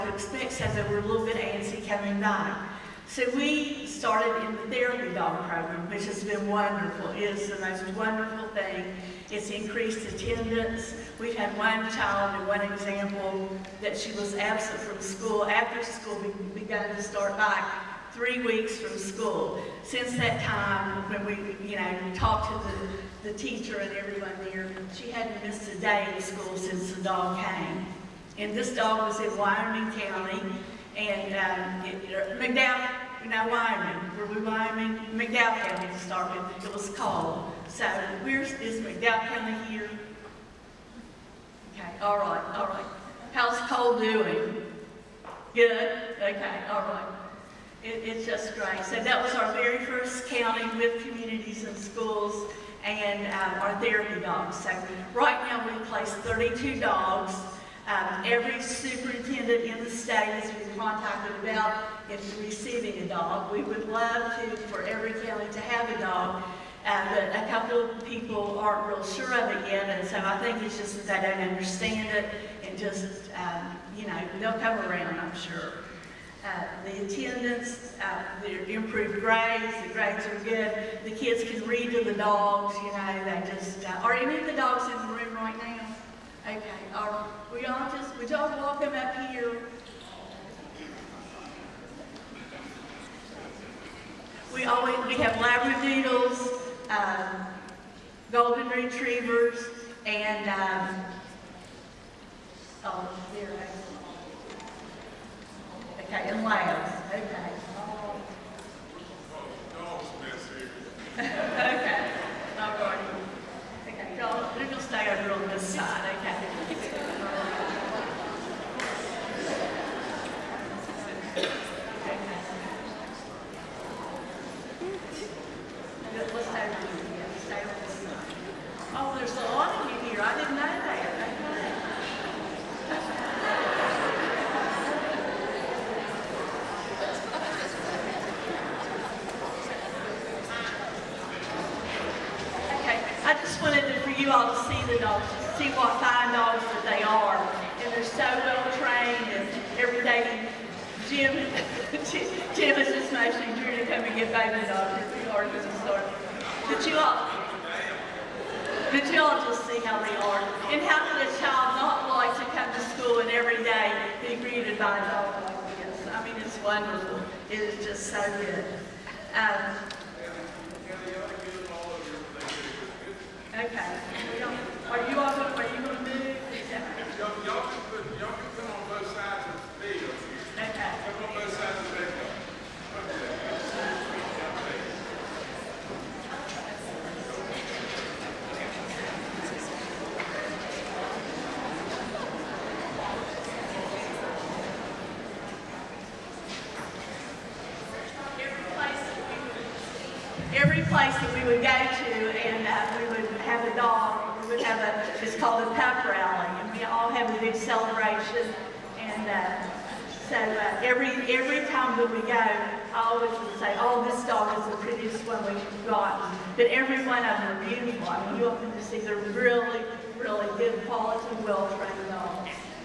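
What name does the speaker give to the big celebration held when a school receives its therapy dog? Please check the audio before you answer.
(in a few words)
pup rally.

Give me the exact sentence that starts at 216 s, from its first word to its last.
But every one of them are beautiful.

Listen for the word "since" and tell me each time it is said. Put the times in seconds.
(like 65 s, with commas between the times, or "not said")
19 s, 26 s.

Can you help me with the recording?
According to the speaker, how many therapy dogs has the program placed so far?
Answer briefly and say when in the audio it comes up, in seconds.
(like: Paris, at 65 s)
32, at 56 s.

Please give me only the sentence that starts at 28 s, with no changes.
And this dog was in Wyoming County, and um, it, uh, McDowell, now Wyoming, were we Wyoming?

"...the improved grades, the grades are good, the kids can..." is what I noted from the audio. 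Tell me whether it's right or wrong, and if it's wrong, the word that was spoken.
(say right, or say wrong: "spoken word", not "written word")
right.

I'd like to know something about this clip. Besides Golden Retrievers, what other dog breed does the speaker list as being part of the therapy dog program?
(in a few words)
Labradoodles.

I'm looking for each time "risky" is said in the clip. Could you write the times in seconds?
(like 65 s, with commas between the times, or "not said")
not said.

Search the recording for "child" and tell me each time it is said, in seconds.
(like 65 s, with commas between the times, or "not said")
11 s, 161 s.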